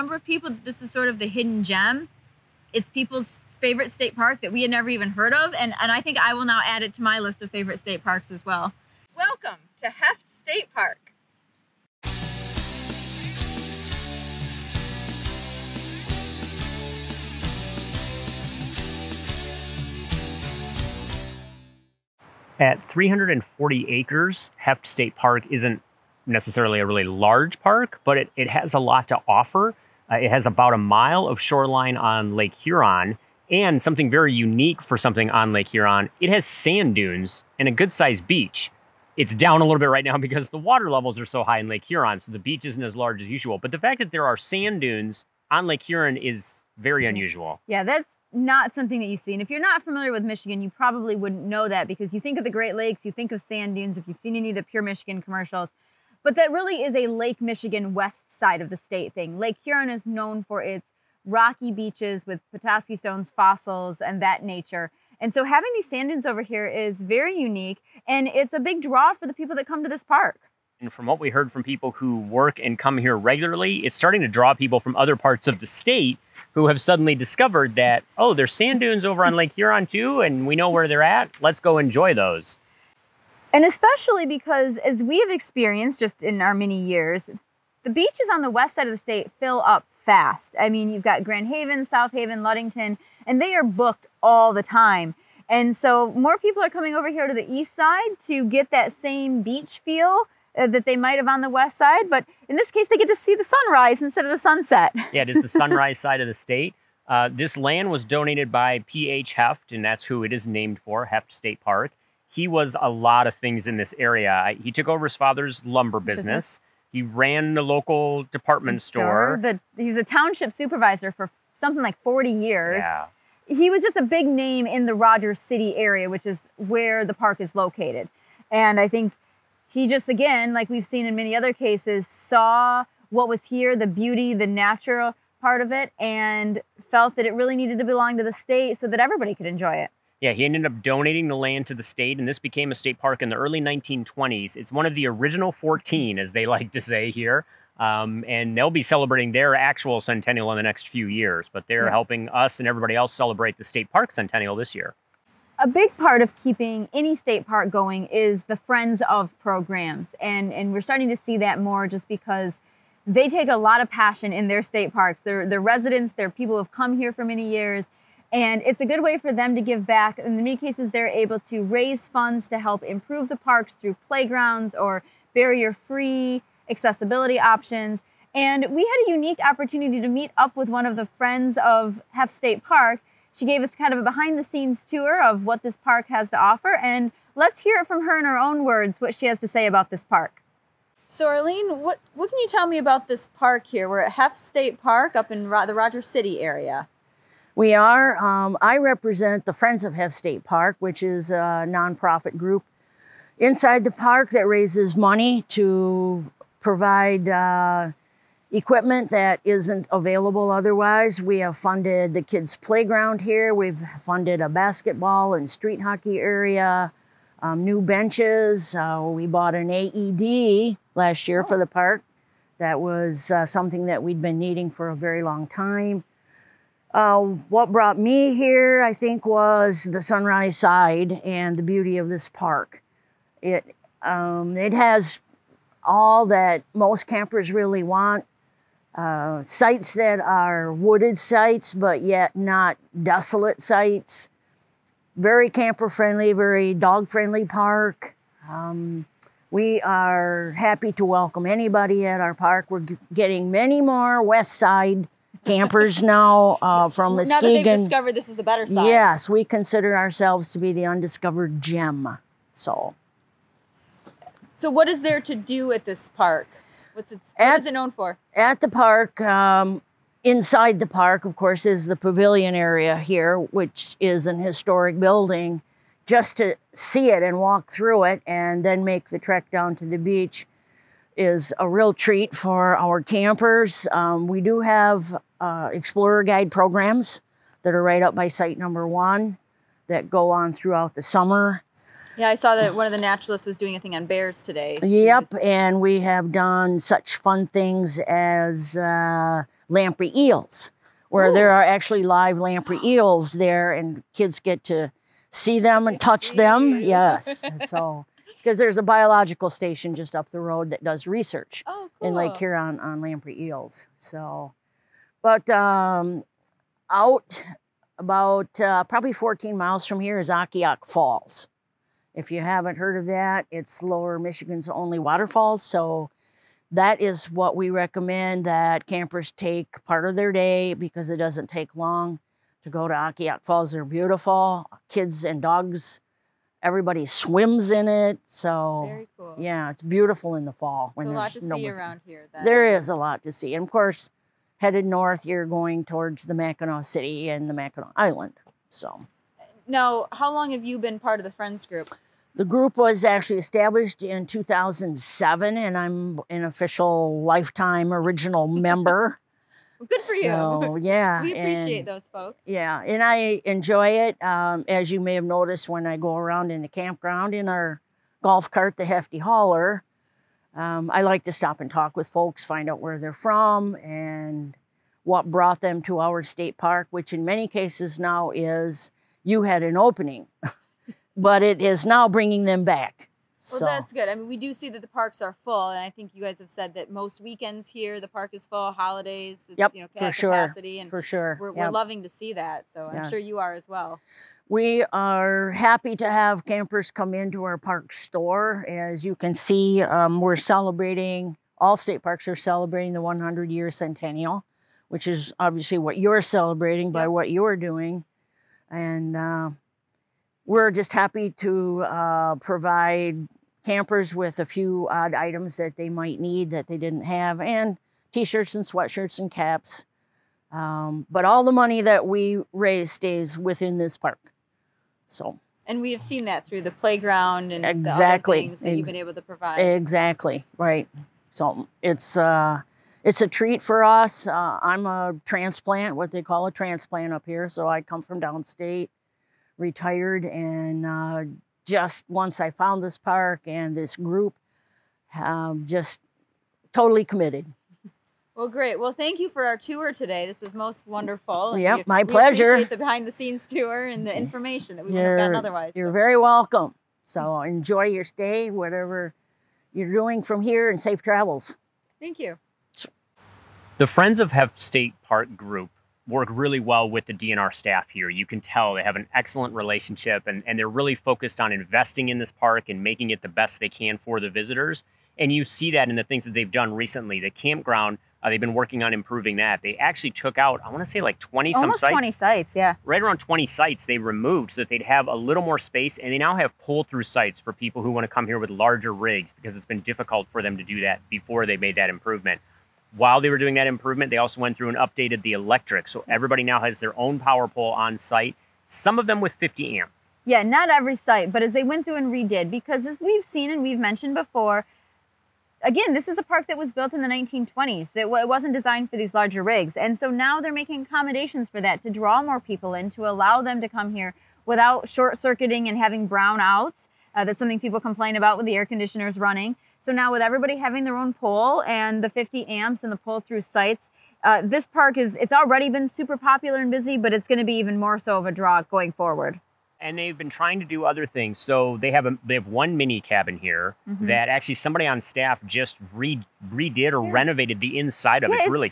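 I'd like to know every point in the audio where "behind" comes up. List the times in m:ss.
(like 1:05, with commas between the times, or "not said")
3:04, 7:32.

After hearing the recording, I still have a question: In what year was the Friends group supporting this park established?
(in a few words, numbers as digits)
2007.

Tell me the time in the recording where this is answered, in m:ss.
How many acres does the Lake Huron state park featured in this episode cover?
0:22.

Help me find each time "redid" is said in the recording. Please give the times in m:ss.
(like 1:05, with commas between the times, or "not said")
8:22, 8:56.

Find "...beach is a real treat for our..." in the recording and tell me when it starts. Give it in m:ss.
4:39.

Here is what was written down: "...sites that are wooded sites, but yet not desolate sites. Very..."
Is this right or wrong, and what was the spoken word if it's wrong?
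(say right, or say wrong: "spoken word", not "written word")
right.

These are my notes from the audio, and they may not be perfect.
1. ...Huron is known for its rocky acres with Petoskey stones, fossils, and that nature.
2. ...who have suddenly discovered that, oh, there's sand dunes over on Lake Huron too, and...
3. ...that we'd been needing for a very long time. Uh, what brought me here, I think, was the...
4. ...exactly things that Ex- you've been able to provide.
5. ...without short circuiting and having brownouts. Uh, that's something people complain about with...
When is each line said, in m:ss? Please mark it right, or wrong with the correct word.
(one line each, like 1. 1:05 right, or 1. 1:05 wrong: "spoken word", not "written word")
1. 0:59 wrong: "beaches", not "acres"
2. 1:16 right
3. 3:43 right
4. 7:07 right
5. 8:34 right.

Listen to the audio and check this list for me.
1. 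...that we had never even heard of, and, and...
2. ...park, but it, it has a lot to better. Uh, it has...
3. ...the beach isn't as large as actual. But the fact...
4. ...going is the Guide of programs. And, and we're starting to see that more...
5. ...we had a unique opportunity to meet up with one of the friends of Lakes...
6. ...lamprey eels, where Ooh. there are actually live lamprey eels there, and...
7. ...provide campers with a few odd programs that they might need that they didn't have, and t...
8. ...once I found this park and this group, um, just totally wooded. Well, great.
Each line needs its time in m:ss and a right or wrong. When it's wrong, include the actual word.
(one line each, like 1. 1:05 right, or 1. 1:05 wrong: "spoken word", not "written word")
1. 0:04 right
2. 0:27 wrong: "offer", not "better"
3. 0:42 wrong: "usual", not "actual"
4. 2:37 wrong: "Friends", not "Guide"
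5. 2:58 wrong: "Hoeft", not "Lakes"
6. 4:59 right
7. 6:52 wrong: "items", not "programs"
8. 7:22 wrong: "committed", not "wooded".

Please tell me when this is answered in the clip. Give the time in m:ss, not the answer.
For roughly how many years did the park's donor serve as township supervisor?
2:02.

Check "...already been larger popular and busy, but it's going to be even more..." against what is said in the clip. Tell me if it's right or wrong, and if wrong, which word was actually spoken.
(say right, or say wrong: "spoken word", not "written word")
wrong: "super", not "larger".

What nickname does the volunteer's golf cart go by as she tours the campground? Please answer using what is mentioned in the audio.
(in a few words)
the hefty hauler.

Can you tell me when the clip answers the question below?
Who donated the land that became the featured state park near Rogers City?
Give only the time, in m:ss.
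1:48.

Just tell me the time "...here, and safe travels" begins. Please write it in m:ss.
7:40.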